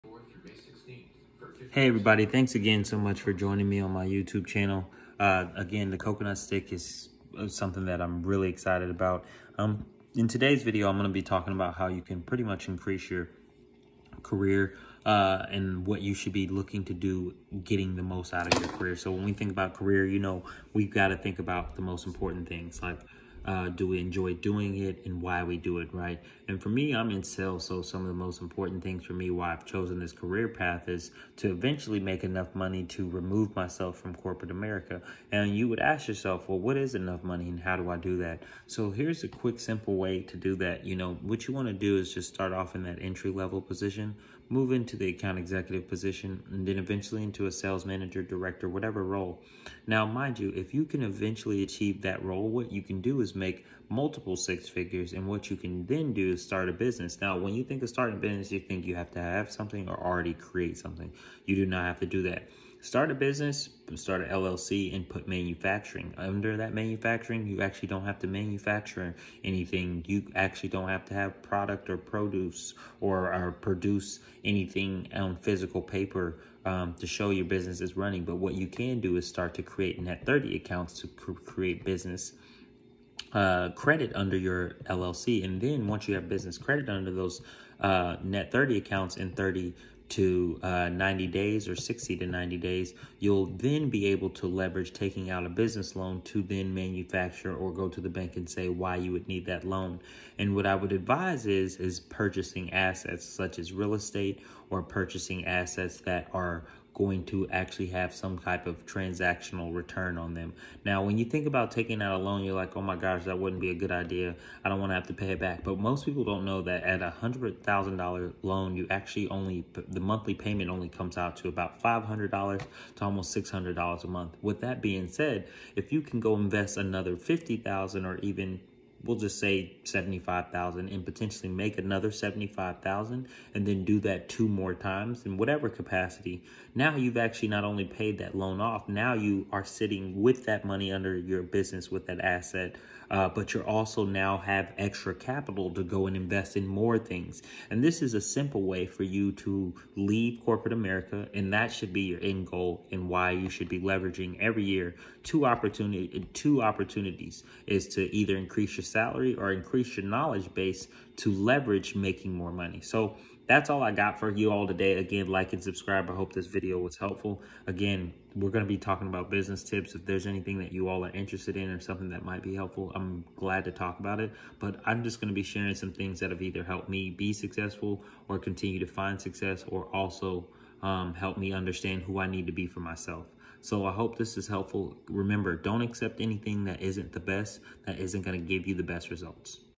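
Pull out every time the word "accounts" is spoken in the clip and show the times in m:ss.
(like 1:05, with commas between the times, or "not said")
0:45, 1:20, 1:28.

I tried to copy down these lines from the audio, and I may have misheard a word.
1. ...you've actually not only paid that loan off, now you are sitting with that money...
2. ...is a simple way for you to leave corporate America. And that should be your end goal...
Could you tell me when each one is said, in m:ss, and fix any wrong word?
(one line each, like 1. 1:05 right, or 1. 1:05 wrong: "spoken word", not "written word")
1. 2:16 right
2. 2:28 right.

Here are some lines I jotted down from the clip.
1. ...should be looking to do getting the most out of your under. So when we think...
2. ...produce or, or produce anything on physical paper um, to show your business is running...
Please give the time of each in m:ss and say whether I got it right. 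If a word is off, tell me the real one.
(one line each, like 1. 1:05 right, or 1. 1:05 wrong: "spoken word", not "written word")
1. 0:16 wrong: "career", not "under"
2. 1:11 right.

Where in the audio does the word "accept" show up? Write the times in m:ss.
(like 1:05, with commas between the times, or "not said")
3:05.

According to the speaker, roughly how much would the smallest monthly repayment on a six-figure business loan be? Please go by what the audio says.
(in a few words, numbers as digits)
$500.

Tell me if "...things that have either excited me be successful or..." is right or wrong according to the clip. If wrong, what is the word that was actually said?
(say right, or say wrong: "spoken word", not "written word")
wrong: "helped", not "excited".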